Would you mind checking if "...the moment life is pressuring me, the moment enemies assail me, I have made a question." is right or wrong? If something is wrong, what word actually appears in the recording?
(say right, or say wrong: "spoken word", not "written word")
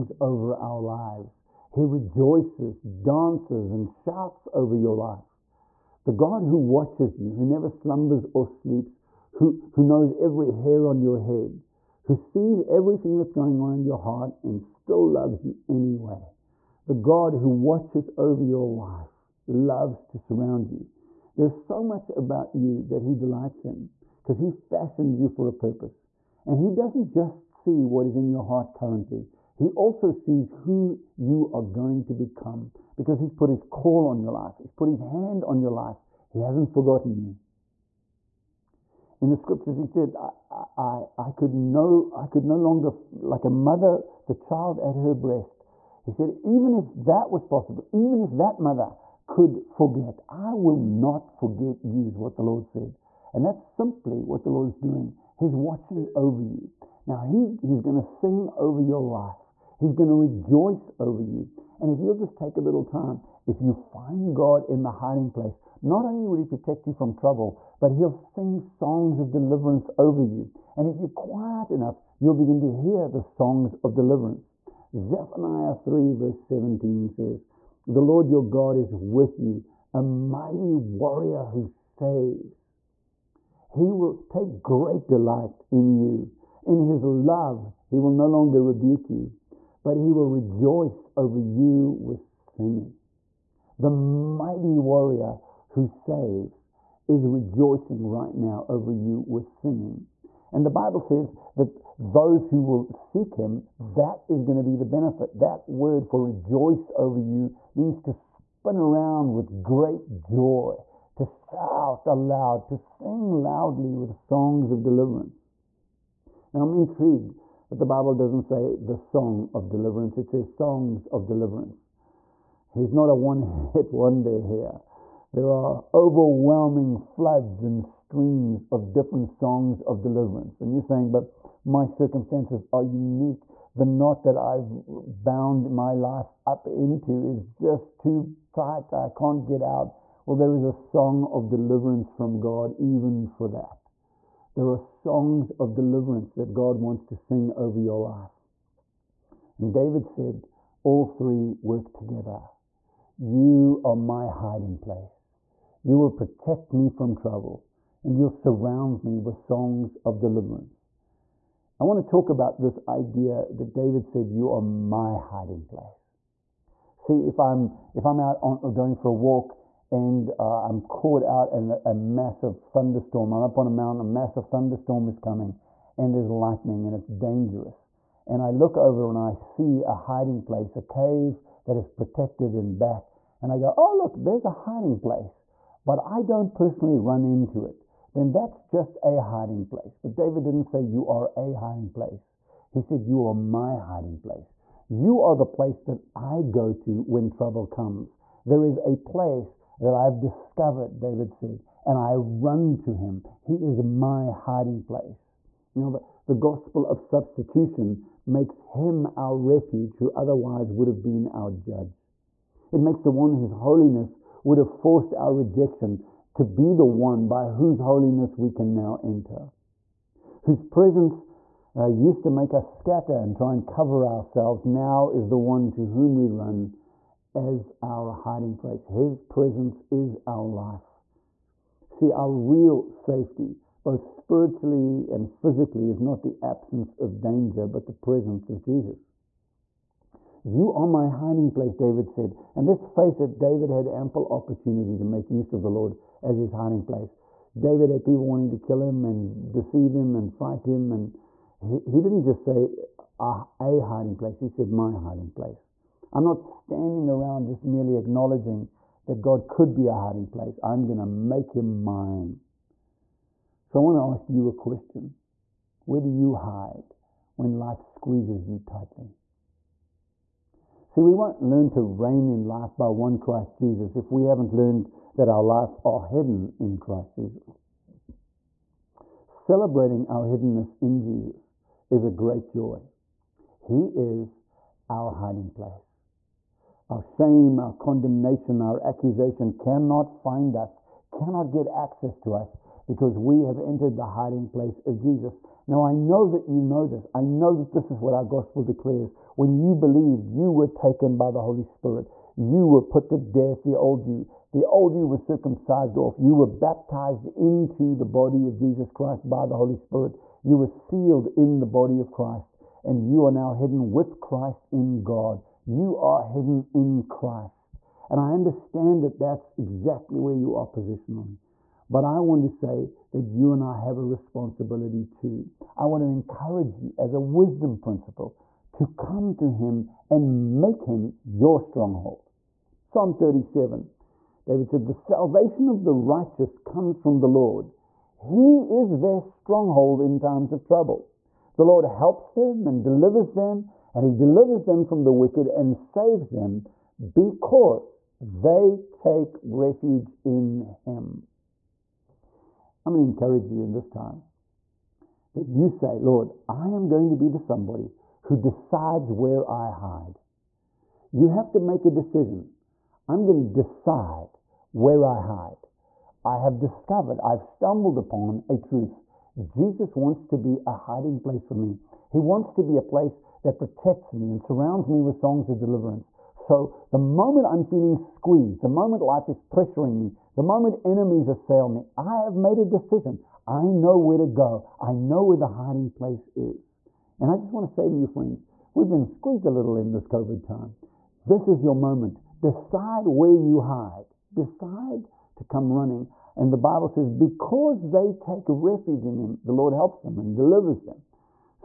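wrong: "decision", not "question".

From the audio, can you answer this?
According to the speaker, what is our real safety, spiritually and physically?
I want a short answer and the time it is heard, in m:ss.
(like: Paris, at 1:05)
The presence of Jesus, at 3:57.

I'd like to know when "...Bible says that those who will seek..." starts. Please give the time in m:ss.
1:40.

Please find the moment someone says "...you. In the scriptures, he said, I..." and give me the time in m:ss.
0:37.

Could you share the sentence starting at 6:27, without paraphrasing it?
And I just want to say to you, friends, we've been squeezed a little in this COVID time.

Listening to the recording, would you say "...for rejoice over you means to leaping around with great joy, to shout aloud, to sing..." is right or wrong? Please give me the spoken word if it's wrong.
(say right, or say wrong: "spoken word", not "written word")
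right.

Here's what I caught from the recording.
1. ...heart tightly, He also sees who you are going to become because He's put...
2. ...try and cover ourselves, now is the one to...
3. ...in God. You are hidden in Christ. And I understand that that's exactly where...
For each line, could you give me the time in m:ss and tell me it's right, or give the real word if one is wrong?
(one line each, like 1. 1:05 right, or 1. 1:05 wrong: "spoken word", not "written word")
1. 0:28 wrong: "currently", not "tightly"
2. 3:43 right
3. 5:14 right.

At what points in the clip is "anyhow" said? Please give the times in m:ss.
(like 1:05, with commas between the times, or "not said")
not said.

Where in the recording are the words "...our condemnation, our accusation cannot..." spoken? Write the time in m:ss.
4:47.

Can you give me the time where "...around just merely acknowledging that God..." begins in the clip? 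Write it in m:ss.
4:17.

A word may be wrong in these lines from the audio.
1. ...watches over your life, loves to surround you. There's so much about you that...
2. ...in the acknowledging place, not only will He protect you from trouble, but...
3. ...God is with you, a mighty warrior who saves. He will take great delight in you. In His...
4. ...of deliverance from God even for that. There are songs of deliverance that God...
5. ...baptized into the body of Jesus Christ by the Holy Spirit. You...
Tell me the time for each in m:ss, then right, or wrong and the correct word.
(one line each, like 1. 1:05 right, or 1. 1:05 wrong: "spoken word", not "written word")
1. 0:17 right
2. 1:04 wrong: "hiding", not "acknowledging"
3. 1:18 right
4. 2:21 right
5. 5:06 right.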